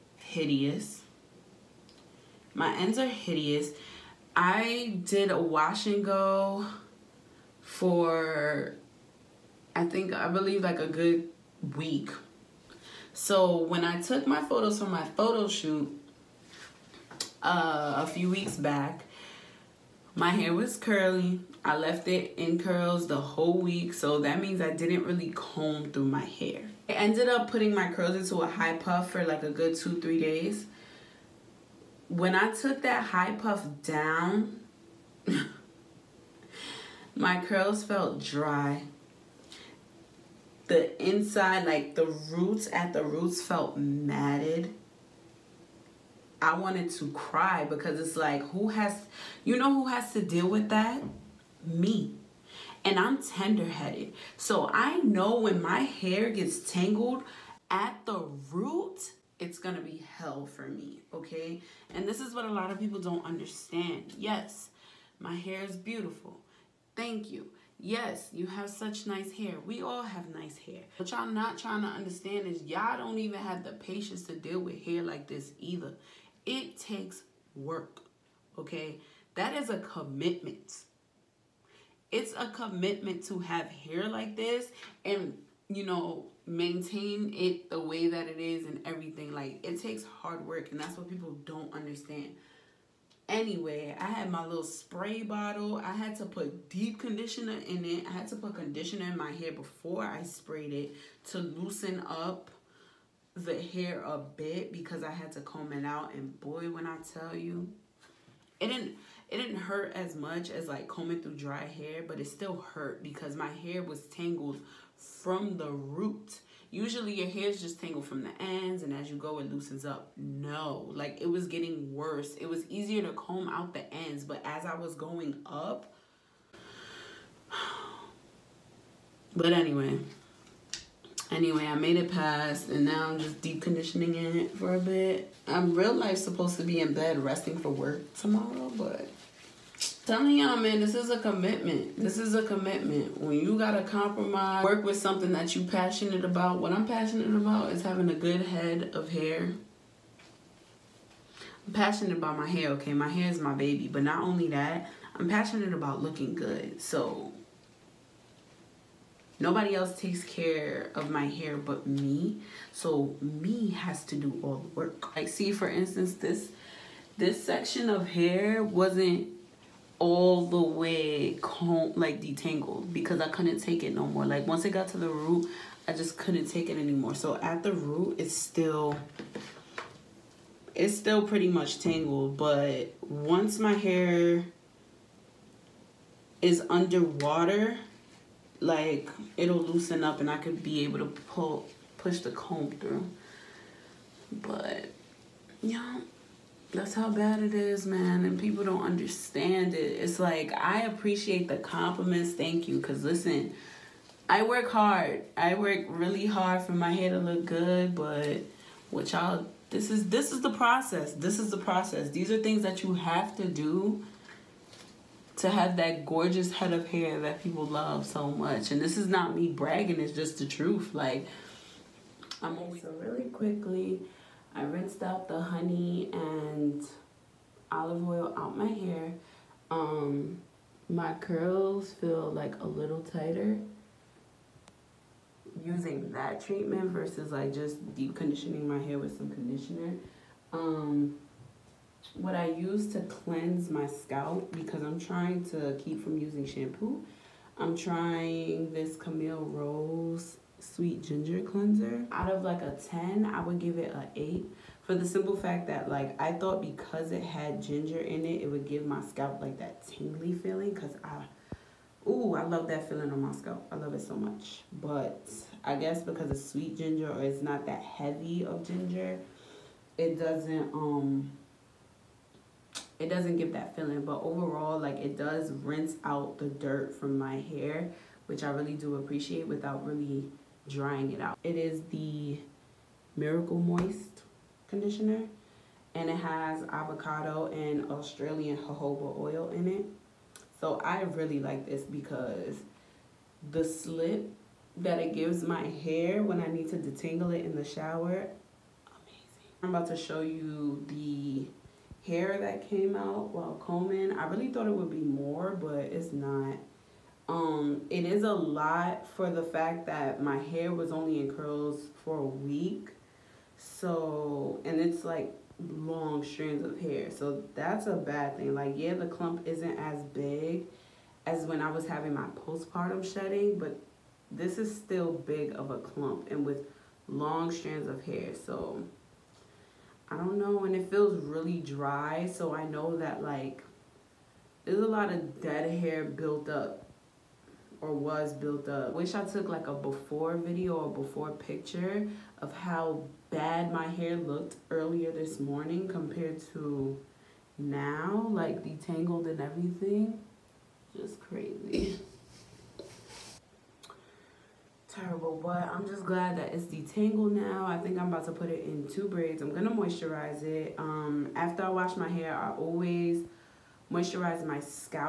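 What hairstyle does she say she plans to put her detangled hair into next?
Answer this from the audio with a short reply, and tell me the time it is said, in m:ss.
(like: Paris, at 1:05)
two braids, at 5:58.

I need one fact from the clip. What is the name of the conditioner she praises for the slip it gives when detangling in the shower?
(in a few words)
Miracle Moist.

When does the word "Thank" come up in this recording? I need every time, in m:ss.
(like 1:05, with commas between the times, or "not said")
1:06, 3:22.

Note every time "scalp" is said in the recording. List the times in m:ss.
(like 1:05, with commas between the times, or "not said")
4:03, 4:19, 4:23.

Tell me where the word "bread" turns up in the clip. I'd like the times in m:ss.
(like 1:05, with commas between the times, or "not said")
not said.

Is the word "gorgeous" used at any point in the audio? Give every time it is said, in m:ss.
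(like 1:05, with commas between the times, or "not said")
3:36.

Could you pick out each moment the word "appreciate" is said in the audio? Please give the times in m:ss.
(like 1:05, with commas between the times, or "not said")
3:20, 4:38.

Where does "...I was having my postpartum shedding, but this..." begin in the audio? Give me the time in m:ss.
5:21.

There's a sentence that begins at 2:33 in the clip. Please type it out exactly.
But not only that, I'm passionate about looking good.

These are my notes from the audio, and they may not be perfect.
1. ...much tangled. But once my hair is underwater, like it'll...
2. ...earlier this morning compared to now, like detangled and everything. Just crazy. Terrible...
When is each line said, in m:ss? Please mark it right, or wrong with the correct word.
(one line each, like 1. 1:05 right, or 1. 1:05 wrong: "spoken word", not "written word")
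1. 3:01 right
2. 5:44 right.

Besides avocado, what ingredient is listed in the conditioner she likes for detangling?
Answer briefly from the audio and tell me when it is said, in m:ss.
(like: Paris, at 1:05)
Australian jojoba oil, at 4:47.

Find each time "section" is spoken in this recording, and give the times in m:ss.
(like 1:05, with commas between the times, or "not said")
2:47.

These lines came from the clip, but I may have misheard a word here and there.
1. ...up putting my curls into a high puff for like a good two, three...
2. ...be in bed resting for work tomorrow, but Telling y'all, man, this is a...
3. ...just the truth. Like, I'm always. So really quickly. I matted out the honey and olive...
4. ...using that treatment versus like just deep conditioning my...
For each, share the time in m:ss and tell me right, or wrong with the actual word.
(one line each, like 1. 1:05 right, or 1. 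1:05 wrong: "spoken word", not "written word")
1. 0:27 right
2. 2:16 right
3. 3:40 wrong: "rinsed", not "matted"
4. 3:55 right.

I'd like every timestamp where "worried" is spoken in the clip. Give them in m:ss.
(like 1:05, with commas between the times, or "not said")
not said.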